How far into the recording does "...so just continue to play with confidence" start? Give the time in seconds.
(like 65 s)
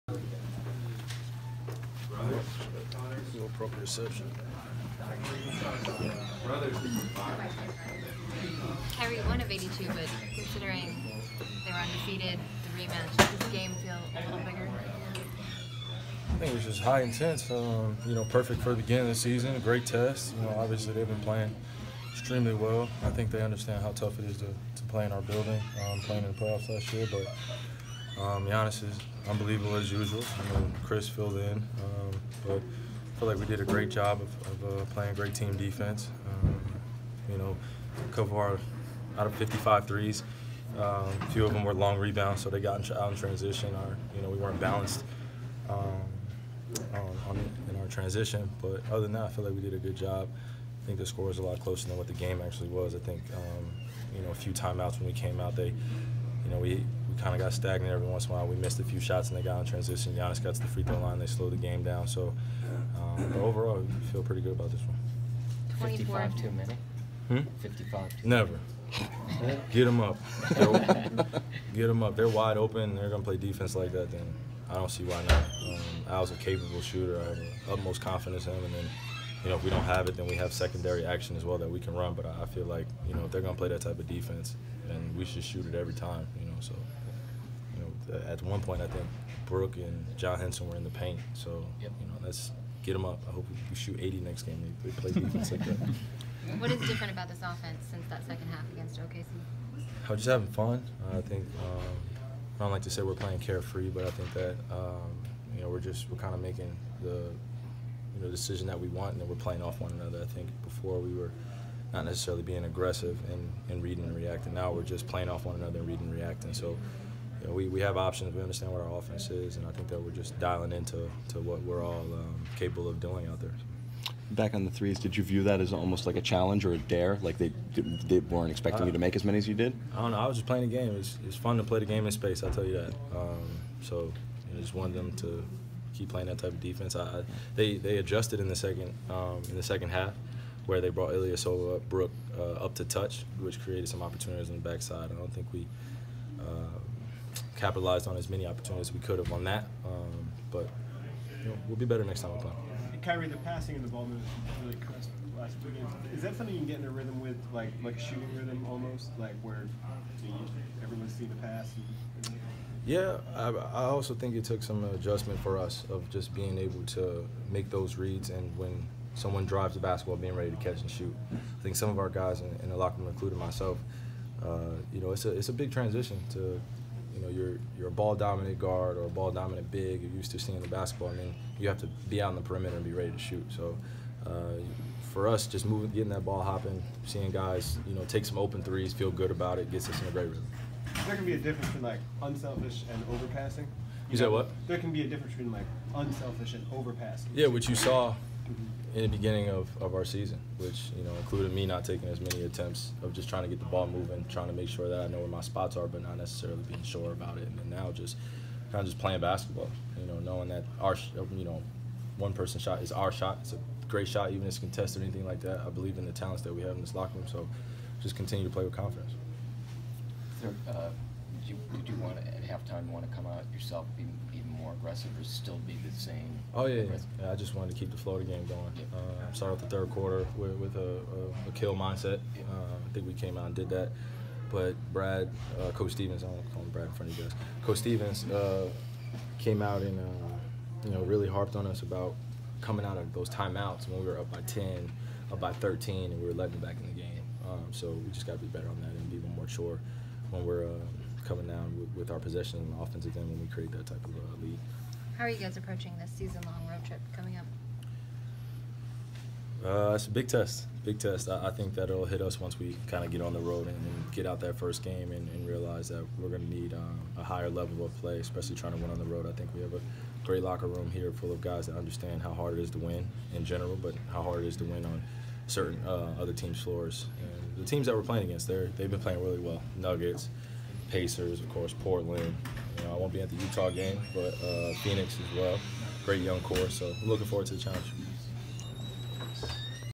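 217 s.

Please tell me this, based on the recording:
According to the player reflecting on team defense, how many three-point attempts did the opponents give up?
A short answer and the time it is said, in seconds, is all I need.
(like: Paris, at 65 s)
55, at 39 s.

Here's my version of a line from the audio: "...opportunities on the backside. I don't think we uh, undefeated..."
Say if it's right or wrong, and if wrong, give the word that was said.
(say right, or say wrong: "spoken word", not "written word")
wrong: "capitalized", not "undefeated".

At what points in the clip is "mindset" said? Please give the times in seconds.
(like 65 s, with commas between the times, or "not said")
231 s.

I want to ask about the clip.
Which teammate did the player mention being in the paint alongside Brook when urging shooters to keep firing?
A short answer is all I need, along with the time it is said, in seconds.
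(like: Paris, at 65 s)
John Henson, at 90 s.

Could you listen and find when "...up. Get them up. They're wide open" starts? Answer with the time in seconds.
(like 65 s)
70 s.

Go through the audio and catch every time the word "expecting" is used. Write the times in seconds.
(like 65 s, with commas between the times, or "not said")
128 s.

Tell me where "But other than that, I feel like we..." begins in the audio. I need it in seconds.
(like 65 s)
48 s.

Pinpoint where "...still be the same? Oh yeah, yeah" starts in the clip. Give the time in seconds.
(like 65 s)
225 s.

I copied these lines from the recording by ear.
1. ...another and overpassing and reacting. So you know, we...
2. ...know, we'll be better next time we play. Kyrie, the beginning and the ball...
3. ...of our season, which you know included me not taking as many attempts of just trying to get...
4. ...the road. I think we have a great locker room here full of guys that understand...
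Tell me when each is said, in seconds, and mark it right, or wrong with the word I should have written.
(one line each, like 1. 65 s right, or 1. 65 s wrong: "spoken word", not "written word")
1. 115 s wrong: "reading", not "overpassing"
2. 151 s wrong: "passing", not "beginning"
3. 199 s right
4. 268 s right.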